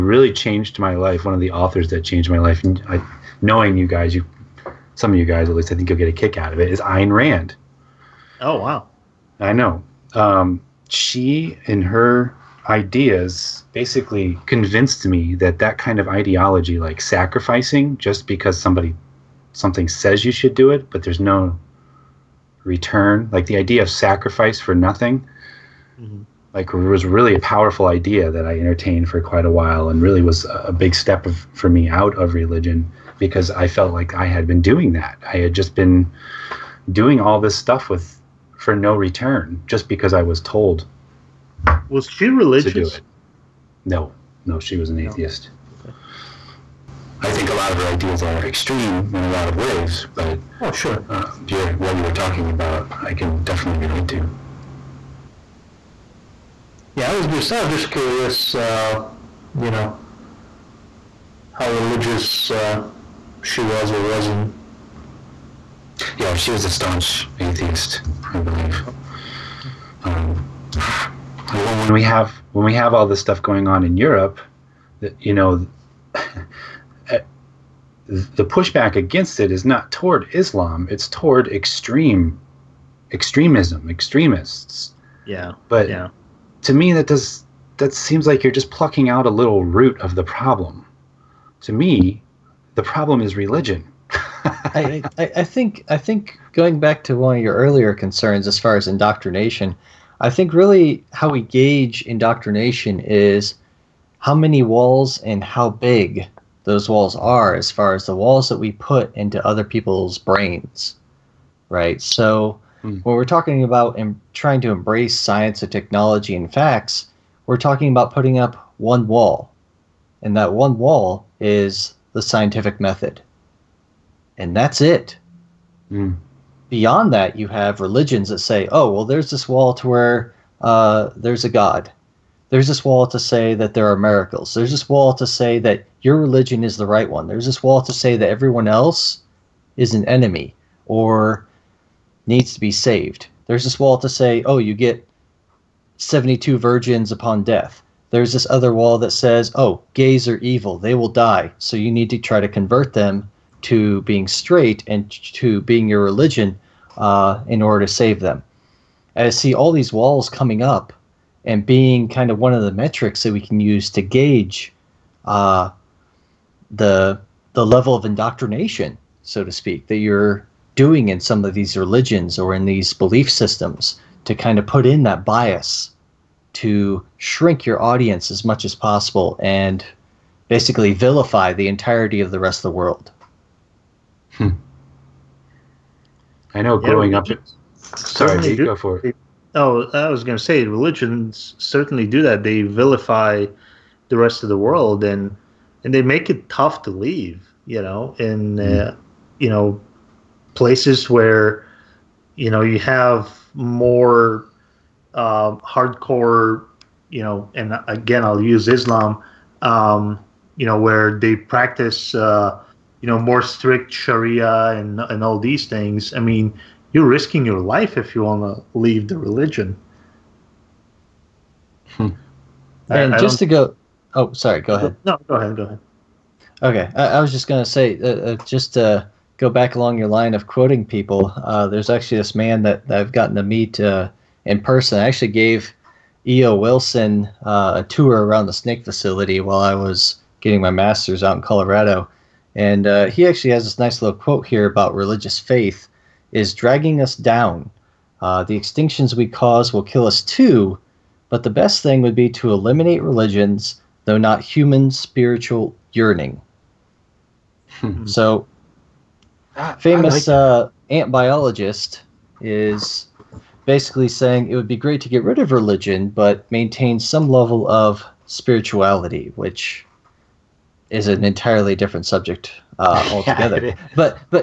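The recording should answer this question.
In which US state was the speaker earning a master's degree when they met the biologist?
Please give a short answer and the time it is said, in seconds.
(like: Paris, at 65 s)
Colorado, at 241 s.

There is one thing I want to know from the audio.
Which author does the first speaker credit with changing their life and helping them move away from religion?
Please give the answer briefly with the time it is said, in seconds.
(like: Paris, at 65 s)
Ayn Rand, at 6 s.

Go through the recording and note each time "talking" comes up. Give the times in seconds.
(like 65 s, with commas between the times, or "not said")
52 s, 113 s, 117 s.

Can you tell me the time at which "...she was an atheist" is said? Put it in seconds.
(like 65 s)
44 s.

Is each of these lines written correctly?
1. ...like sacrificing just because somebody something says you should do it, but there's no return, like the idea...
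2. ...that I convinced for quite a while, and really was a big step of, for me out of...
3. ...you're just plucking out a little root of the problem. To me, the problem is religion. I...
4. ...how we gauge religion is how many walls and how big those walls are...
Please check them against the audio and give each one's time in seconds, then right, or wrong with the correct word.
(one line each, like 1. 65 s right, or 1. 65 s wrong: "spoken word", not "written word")
1. 16 s right
2. 28 s wrong: "entertained", not "convinced"
3. 88 s right
4. 101 s wrong: "indoctrination", not "religion".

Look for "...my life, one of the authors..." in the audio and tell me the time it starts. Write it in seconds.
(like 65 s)
0 s.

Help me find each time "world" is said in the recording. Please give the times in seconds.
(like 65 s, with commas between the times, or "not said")
182 s, 194 s.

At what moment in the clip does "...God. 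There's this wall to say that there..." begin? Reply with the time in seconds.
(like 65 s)
131 s.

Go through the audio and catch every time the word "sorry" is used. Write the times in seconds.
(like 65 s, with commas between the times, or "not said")
187 s, 224 s.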